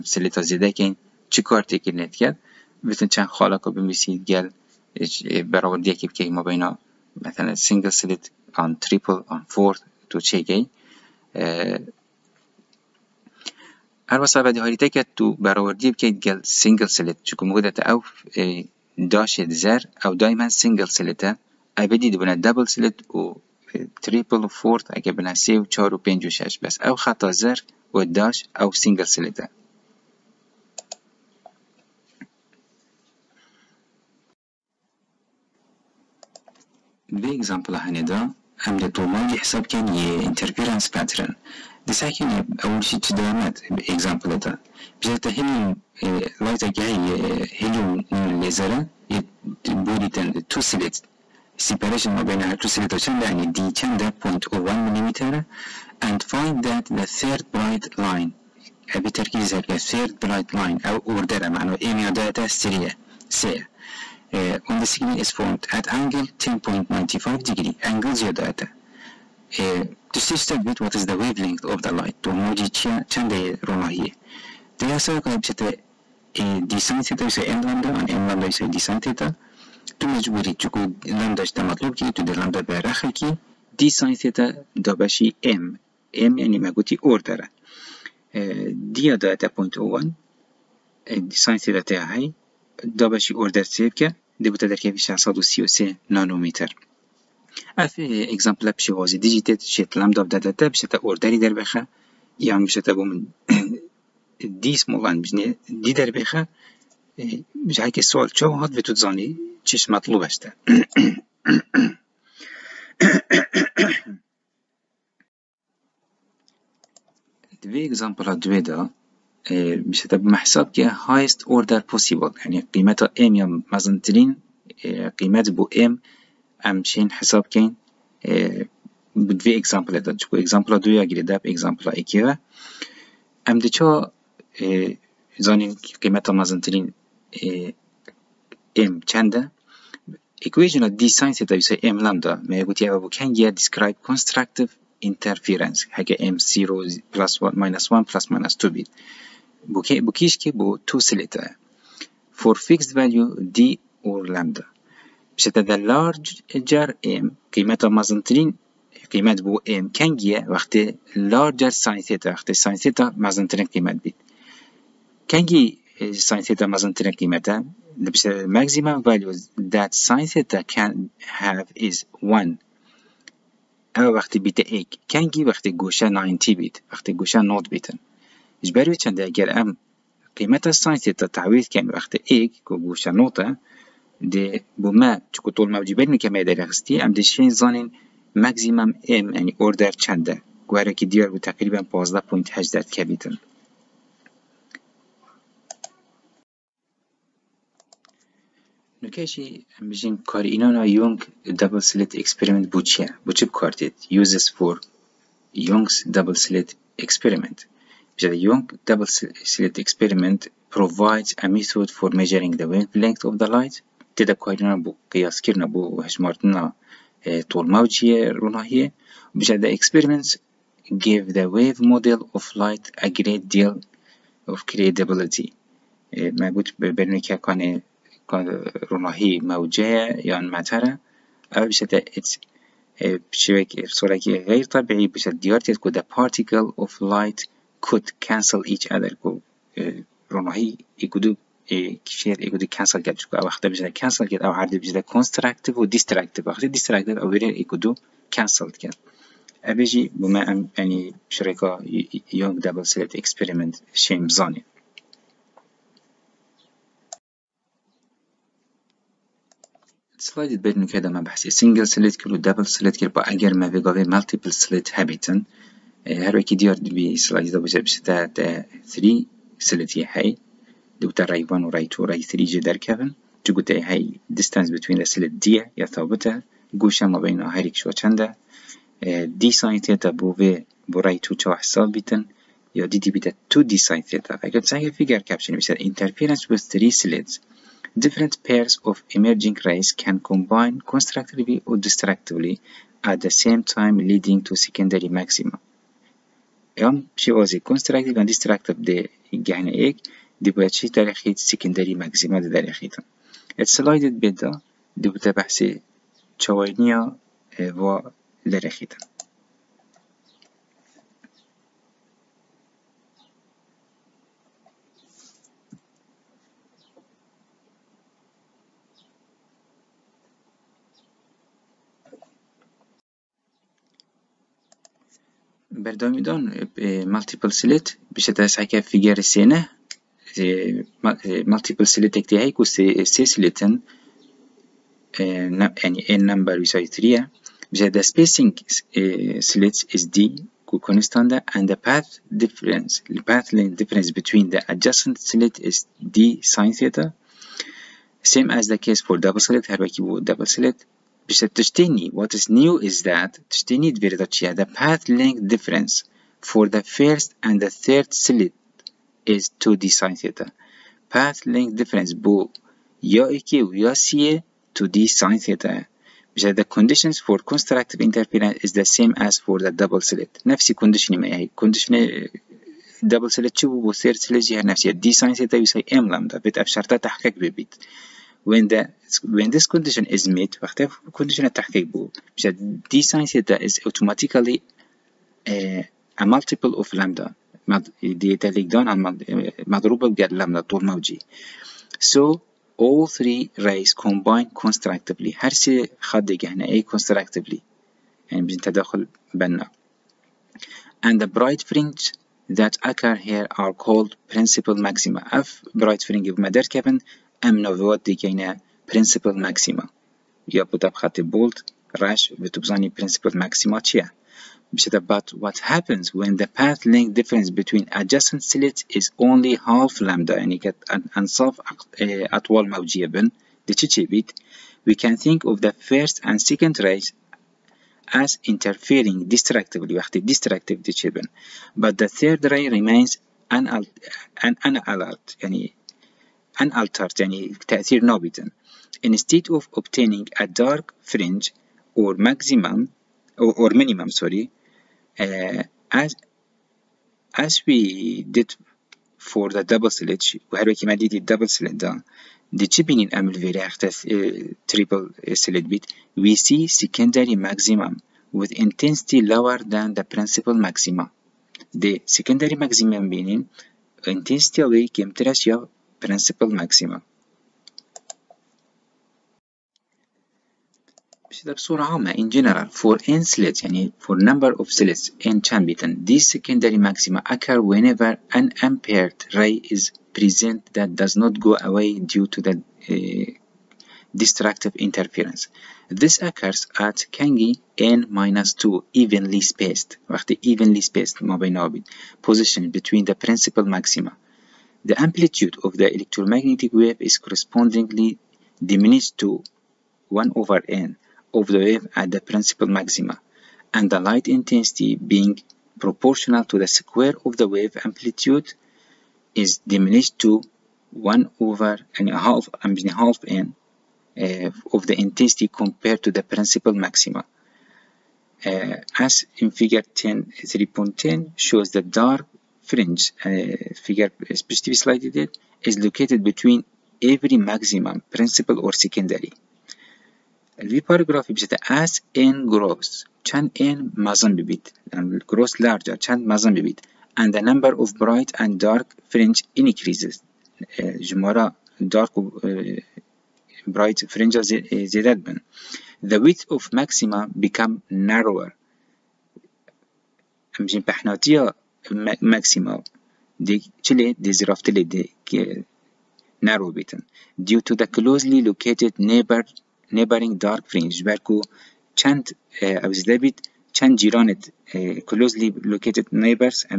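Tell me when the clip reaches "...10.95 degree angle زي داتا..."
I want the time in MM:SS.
01:06.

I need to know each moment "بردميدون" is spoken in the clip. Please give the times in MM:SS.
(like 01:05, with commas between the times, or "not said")
05:25.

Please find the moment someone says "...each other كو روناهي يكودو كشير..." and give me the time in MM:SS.
03:58.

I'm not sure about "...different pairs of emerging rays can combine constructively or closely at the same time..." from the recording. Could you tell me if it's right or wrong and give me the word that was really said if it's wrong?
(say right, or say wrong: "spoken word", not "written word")
wrong: "destructively", not "closely".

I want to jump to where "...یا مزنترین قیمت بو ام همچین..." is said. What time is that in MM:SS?
02:03.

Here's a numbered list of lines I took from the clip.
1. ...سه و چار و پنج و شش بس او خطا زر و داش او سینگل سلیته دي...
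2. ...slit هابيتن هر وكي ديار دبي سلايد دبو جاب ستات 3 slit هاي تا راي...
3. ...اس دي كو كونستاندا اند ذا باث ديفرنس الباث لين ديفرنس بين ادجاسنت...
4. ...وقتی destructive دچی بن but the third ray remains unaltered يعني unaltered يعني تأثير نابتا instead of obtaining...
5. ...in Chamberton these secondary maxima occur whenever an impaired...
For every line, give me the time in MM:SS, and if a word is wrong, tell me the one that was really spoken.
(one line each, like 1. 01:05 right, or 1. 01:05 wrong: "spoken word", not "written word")
1. 00:25 right
2. 04:24 right
3. 05:39 right
4. 07:10 right
5. 07:55 right.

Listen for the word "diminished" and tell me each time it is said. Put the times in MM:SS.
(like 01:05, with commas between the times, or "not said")
08:18, 08:29.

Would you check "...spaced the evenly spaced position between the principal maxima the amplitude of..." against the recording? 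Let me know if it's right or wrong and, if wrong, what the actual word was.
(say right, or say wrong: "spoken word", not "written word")
right.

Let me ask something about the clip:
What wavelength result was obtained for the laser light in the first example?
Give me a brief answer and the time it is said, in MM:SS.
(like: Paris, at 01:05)
633 nanometers, at 01:34.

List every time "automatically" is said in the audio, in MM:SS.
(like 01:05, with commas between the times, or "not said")
06:23.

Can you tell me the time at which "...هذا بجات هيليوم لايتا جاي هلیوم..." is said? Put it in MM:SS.
00:44.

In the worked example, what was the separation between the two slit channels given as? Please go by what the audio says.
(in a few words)
0.01 mm.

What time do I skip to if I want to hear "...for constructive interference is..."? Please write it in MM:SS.
06:07.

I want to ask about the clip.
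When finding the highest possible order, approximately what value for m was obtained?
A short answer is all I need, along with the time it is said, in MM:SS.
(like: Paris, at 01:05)
15.18, at 03:12.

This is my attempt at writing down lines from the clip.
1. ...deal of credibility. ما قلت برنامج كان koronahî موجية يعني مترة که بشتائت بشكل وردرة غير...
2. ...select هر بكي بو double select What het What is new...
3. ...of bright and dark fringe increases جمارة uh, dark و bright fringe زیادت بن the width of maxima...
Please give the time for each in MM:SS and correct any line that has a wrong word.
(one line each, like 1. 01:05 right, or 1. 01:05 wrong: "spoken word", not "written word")
1. 03:43 wrong: "بصورة", not "وردرة"
2. 05:49 wrong: "Dus", not "What"
3. 08:57 right.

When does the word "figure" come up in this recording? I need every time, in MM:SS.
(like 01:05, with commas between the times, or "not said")
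08:39, 08:43.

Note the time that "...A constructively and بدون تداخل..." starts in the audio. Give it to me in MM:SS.
06:36.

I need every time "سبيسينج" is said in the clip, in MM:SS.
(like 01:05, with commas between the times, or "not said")
05:38.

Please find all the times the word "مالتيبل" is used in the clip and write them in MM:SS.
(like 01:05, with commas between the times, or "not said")
04:24, 05:27, 05:31.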